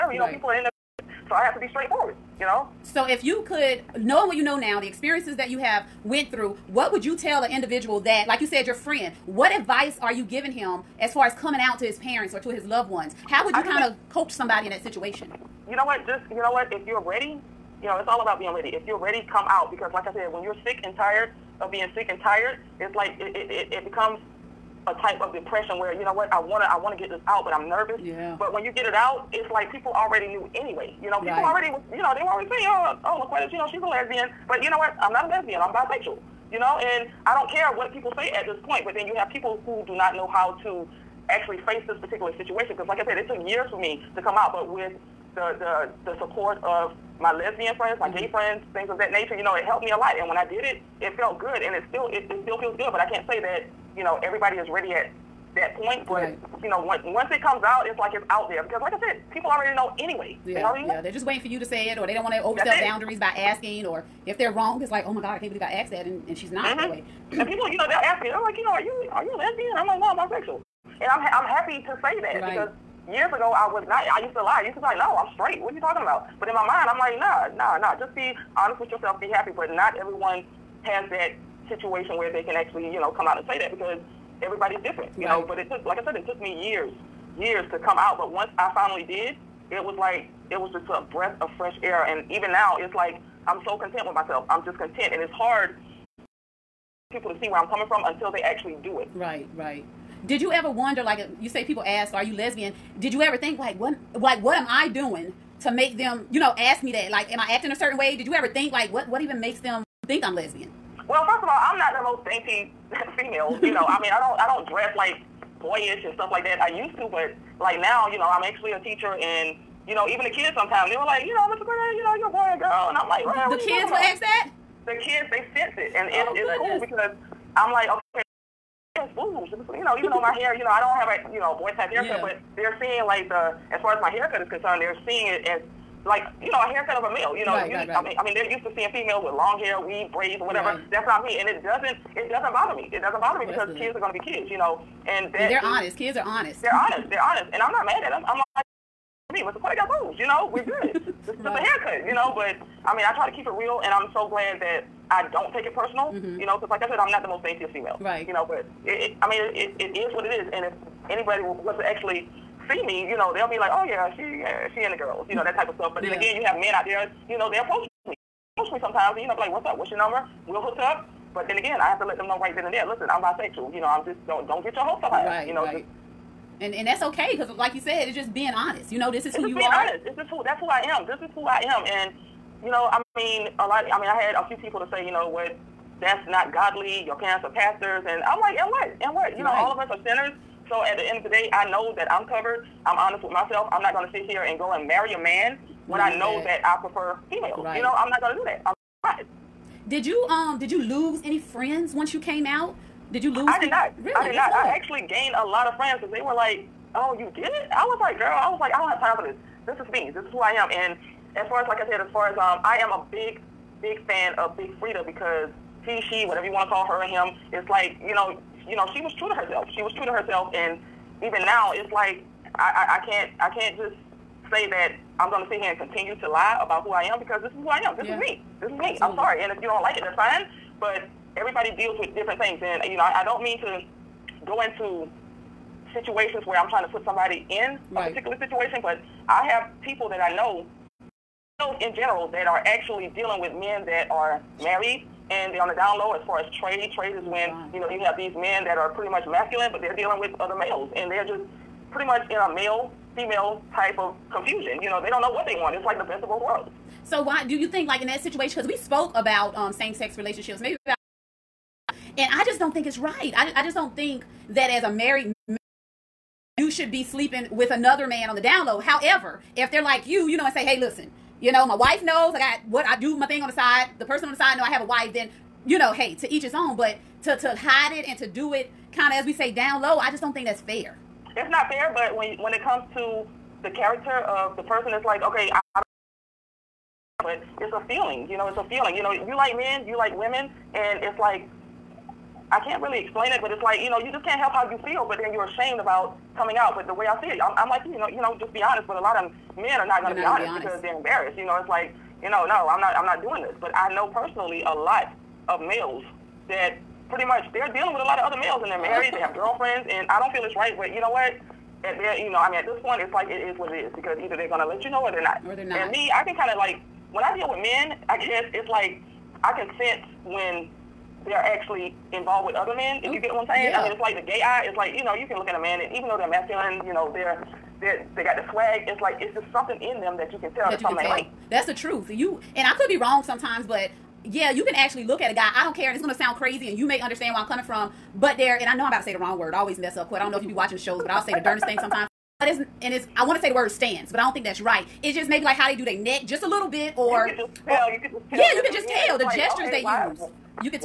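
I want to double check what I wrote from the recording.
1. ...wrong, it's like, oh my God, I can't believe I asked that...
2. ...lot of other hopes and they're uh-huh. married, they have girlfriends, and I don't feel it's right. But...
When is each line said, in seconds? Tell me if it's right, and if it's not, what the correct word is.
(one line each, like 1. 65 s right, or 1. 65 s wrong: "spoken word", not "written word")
1. 64 s right
2. 308 s wrong: "males", not "hopes".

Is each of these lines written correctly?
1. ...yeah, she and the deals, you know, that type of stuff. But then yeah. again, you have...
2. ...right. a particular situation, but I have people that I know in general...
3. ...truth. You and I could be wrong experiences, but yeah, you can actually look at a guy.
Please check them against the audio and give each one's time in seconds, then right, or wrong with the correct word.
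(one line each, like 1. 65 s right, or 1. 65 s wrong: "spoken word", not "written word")
1. 164 s wrong: "girls", not "deals"
2. 237 s right
3. 331 s wrong: "sometimes", not "experiences".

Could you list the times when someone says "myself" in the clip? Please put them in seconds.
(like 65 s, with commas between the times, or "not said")
94 s, 193 s.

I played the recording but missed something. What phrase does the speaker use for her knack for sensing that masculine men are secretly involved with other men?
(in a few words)
The gay eye.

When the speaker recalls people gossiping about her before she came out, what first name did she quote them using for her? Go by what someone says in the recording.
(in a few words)
LaQuetta.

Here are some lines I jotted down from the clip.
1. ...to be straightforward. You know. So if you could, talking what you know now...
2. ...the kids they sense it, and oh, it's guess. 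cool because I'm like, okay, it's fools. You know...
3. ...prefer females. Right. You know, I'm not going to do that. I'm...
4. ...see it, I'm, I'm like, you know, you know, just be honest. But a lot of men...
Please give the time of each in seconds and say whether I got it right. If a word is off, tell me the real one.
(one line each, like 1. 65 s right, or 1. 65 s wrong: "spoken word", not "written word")
1. 1 s wrong: "knowing", not "talking"
2. 124 s wrong: "goodness", not "guess"
3. 196 s right
4. 297 s right.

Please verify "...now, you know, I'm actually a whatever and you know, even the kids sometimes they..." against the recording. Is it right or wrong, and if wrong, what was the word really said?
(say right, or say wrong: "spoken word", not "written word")
wrong: "teacher", not "whatever".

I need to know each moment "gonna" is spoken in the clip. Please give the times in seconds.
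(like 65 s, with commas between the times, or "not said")
314 s, 336 s.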